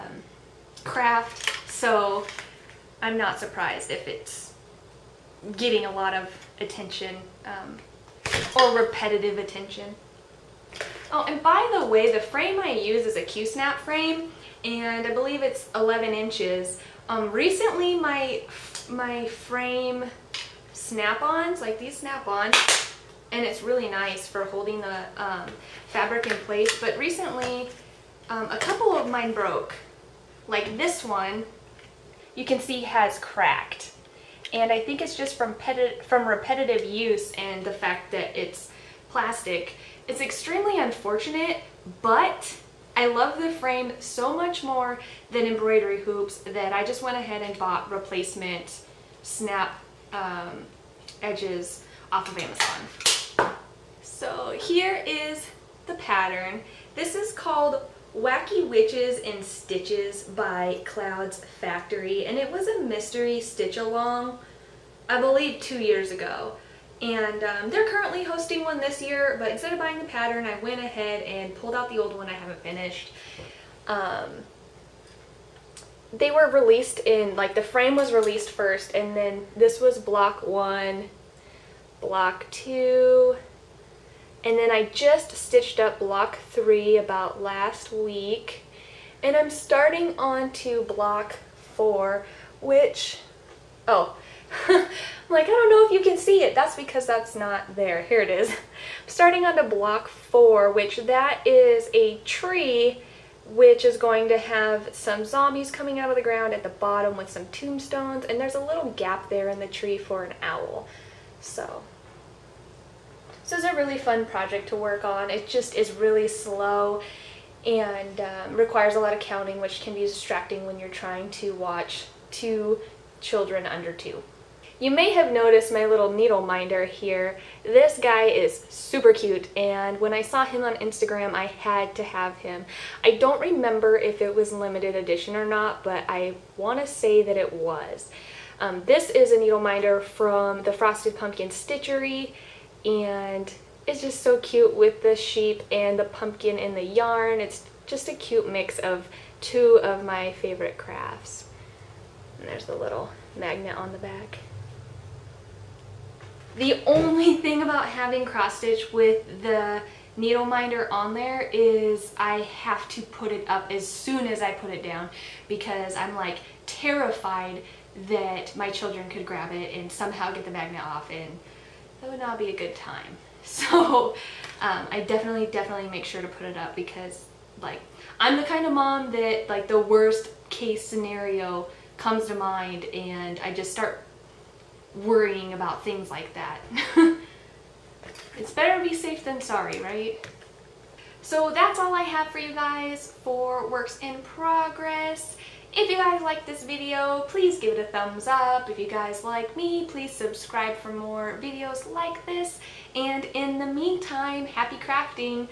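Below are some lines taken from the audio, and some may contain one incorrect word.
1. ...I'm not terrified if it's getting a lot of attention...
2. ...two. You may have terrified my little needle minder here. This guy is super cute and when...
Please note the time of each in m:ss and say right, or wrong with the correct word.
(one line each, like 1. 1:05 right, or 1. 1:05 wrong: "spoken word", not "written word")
1. 0:03 wrong: "surprised", not "terrified"
2. 2:03 wrong: "noticed", not "terrified".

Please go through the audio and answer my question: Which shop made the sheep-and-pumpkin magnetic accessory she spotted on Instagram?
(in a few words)
Frosted Pumpkin Stitchery.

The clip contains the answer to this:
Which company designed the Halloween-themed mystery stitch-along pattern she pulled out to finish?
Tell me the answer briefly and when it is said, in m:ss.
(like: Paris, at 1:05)
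Clouds Factory, at 1:00.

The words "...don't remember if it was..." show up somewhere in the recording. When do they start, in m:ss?
2:13.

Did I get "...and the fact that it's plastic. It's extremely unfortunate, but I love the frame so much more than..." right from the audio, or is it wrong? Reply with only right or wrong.
right.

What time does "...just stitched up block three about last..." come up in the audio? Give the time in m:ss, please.
1:24.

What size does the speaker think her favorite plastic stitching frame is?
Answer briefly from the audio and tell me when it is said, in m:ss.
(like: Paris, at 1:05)
11 inches, at 0:15.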